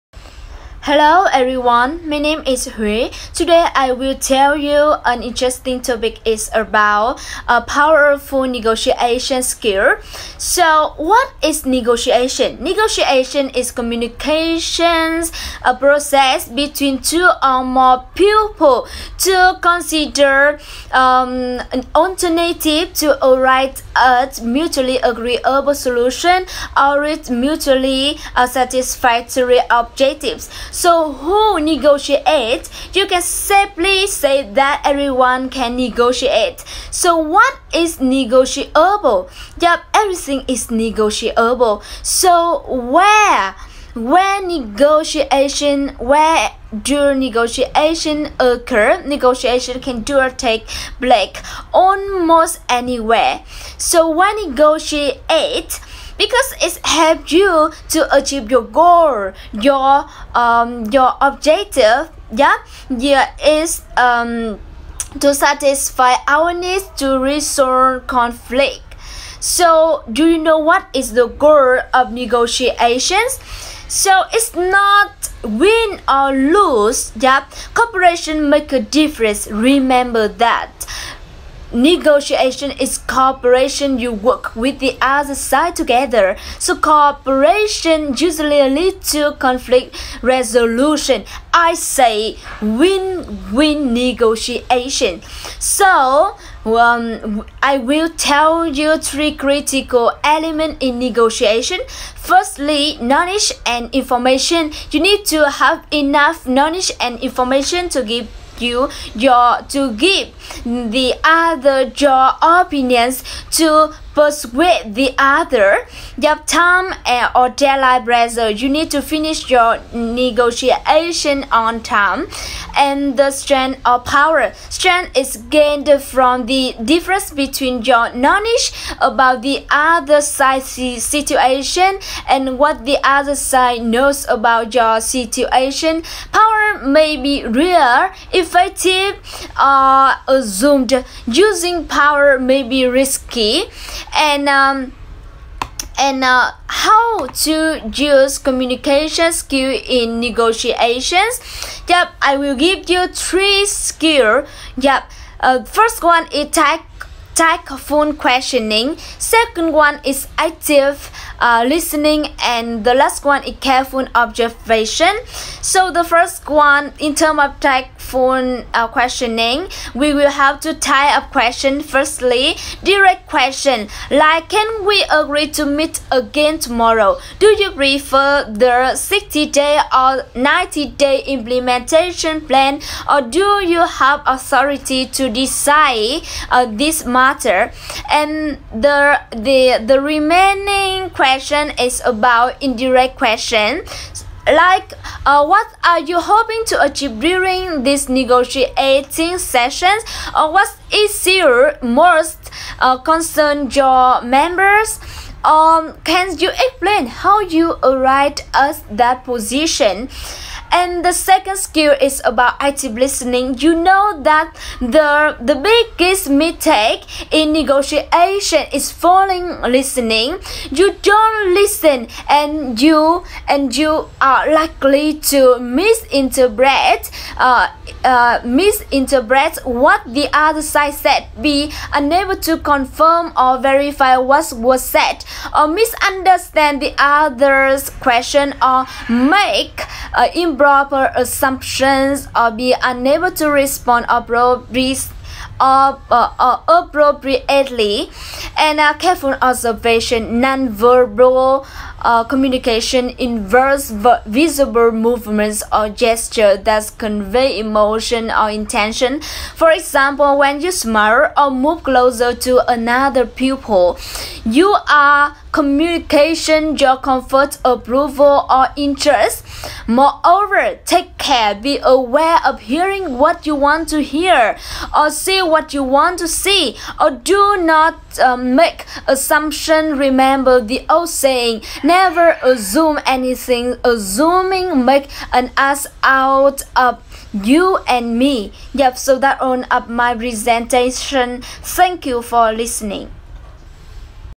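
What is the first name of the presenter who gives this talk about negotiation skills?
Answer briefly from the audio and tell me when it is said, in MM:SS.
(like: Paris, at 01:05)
Hui, at 00:02.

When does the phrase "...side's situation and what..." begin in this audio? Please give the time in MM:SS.
02:10.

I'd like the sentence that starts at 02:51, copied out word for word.
Firstly, direct question like can we agree to meet again tomorrow?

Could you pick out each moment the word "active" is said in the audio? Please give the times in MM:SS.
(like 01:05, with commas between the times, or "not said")
02:40, 03:32.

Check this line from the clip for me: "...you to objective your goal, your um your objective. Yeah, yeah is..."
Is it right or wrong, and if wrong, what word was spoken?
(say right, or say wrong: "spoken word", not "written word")
wrong: "achieve", not "objective".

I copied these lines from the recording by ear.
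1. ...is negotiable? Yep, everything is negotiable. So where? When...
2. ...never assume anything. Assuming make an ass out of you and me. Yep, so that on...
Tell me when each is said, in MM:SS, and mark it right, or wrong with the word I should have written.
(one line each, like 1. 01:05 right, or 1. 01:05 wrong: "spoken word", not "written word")
1. 00:37 right
2. 04:41 right.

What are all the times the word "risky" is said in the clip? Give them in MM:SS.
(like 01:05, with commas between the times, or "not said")
02:22.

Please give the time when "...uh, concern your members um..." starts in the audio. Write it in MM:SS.
03:22.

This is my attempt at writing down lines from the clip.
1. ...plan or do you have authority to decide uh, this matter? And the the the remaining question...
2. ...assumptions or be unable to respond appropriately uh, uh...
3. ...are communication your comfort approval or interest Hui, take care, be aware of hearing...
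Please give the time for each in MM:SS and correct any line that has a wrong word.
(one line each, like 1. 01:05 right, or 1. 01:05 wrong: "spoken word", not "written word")
1. 03:02 right
2. 04:01 right
3. 04:24 wrong: "Moreover", not "Hui".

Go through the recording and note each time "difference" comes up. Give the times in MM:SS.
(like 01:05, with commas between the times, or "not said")
01:18, 02:06.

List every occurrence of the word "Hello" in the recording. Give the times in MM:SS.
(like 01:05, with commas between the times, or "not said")
00:00.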